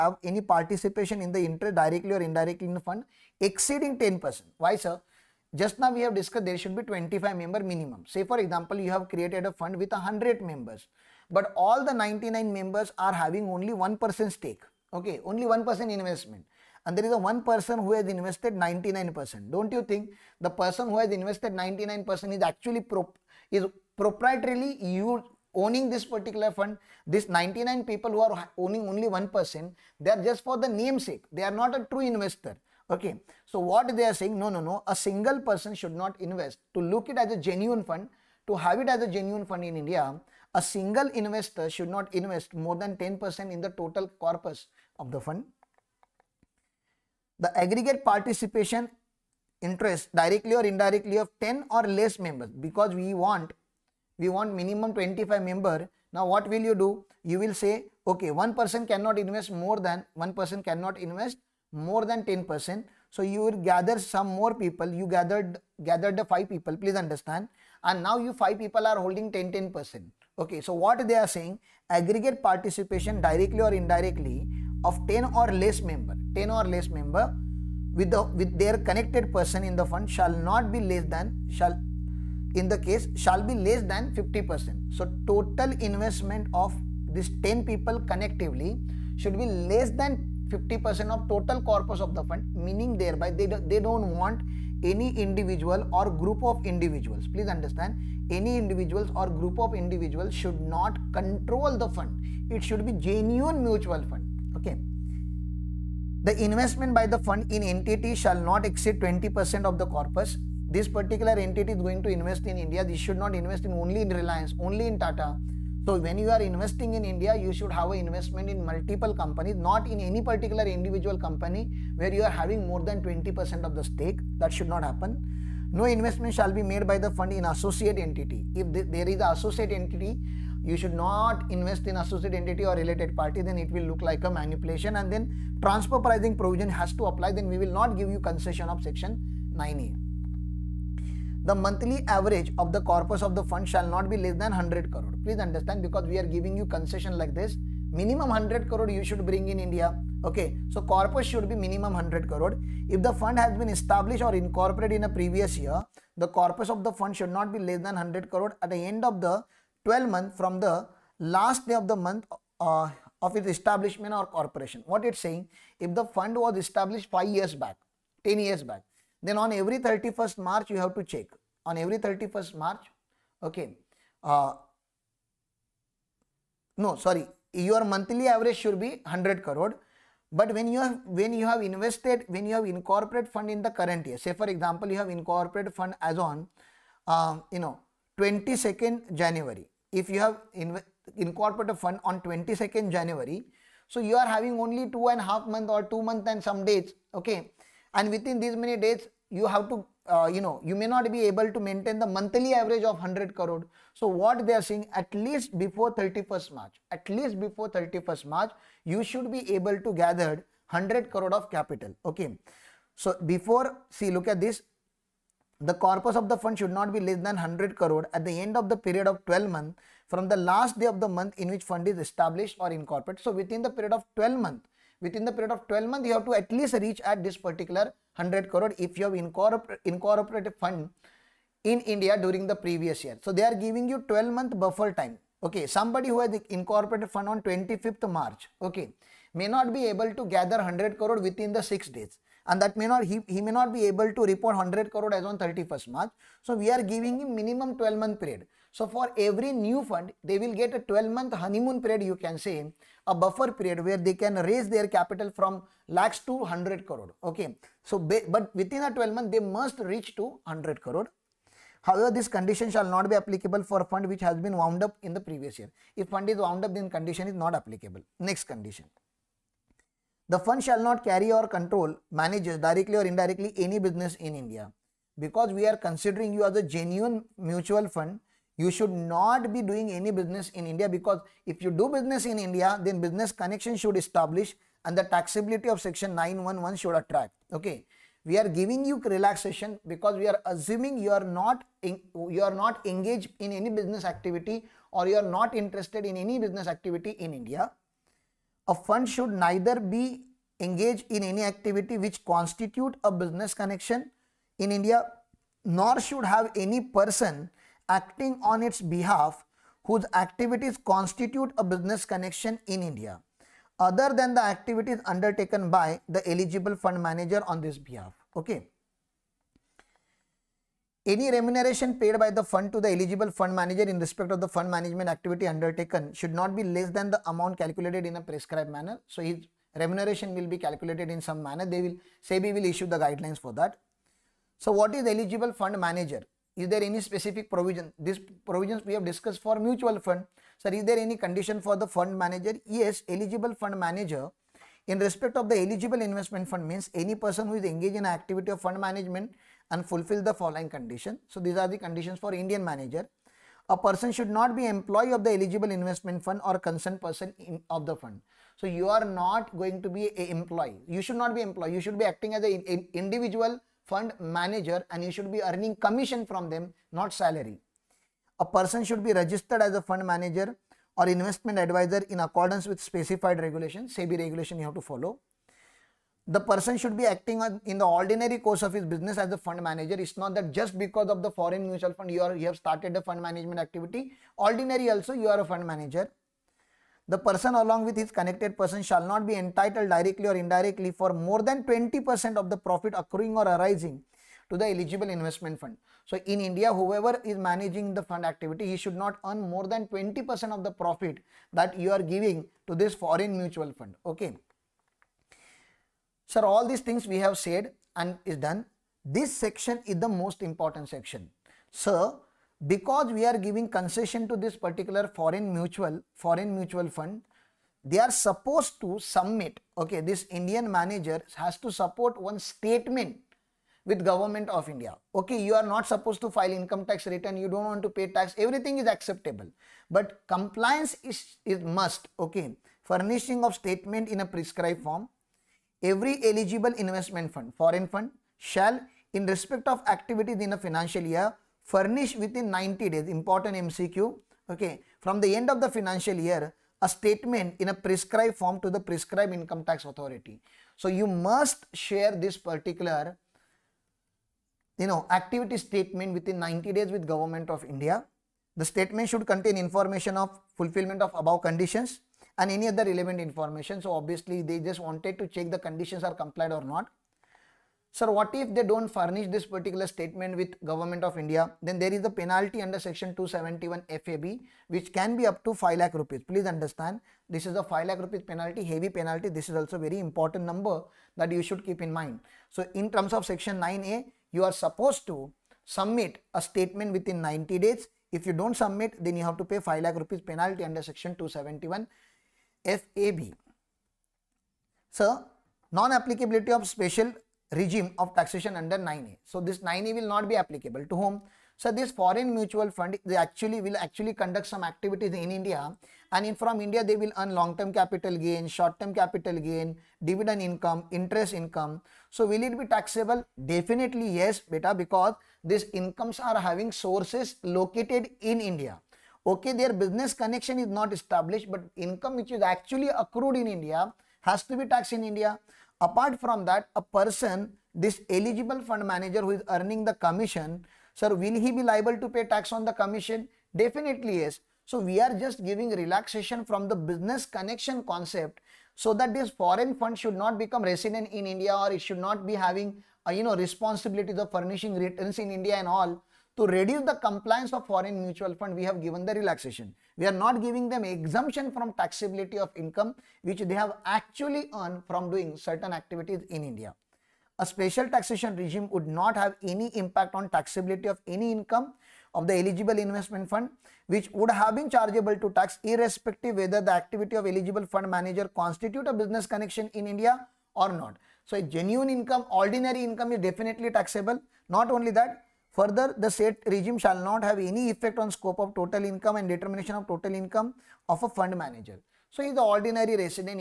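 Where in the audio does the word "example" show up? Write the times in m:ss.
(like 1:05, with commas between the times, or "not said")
0:08, 3:04.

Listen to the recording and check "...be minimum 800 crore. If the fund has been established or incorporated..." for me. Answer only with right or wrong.
wrong.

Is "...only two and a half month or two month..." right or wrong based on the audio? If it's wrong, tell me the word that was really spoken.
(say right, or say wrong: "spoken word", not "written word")
right.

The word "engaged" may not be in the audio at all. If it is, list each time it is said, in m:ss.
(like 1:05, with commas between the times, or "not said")
4:52, 5:00, 5:47.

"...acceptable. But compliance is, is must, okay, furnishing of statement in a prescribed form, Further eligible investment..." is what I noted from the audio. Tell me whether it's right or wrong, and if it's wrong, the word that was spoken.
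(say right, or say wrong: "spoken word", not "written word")
wrong: "Every", not "Further".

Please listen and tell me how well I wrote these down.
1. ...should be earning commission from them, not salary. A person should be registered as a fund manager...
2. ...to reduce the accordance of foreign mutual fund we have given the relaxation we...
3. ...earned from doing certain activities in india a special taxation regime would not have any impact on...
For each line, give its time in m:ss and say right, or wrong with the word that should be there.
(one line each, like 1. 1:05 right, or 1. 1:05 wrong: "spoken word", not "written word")
1. 6:05 right
2. 9:06 wrong: "compliance", not "accordance"
3. 9:14 right.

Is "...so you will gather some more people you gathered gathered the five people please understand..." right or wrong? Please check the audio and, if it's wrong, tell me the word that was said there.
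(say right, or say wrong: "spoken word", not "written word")
right.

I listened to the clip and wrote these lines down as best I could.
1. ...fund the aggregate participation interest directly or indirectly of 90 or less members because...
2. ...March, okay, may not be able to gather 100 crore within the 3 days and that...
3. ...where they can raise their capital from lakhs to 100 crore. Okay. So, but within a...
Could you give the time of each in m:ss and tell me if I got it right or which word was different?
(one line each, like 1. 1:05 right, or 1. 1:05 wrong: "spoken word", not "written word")
1. 0:45 wrong: "10", not "90"
2. 3:58 wrong: "6", not "3"
3. 4:13 right.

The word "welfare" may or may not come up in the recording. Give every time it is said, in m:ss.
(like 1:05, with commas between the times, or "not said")
not said.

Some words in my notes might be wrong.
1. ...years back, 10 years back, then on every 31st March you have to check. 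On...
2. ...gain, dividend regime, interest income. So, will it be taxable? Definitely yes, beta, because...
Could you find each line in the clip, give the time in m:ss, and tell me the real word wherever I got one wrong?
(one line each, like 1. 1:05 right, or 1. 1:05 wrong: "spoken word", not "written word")
1. 2:47 right
2. 8:29 wrong: "income", not "regime".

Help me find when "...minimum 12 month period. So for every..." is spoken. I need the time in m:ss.
4:07.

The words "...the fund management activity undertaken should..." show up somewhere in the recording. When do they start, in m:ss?
5:24.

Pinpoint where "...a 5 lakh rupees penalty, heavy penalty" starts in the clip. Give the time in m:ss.
7:57.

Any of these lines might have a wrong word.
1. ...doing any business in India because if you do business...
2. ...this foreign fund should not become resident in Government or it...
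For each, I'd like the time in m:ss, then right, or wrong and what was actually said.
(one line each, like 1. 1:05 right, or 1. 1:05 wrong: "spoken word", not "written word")
1. 4:39 right
2. 8:59 wrong: "India", not "Government".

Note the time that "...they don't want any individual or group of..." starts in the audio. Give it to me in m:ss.
1:33.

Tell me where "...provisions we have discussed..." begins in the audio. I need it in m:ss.
5:38.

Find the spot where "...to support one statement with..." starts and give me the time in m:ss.
7:01.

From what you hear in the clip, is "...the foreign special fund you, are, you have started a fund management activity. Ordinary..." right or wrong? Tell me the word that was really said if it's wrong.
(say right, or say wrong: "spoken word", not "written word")
wrong: "mutual", not "special".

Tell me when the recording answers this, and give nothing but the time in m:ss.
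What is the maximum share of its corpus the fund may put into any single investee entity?
1:49.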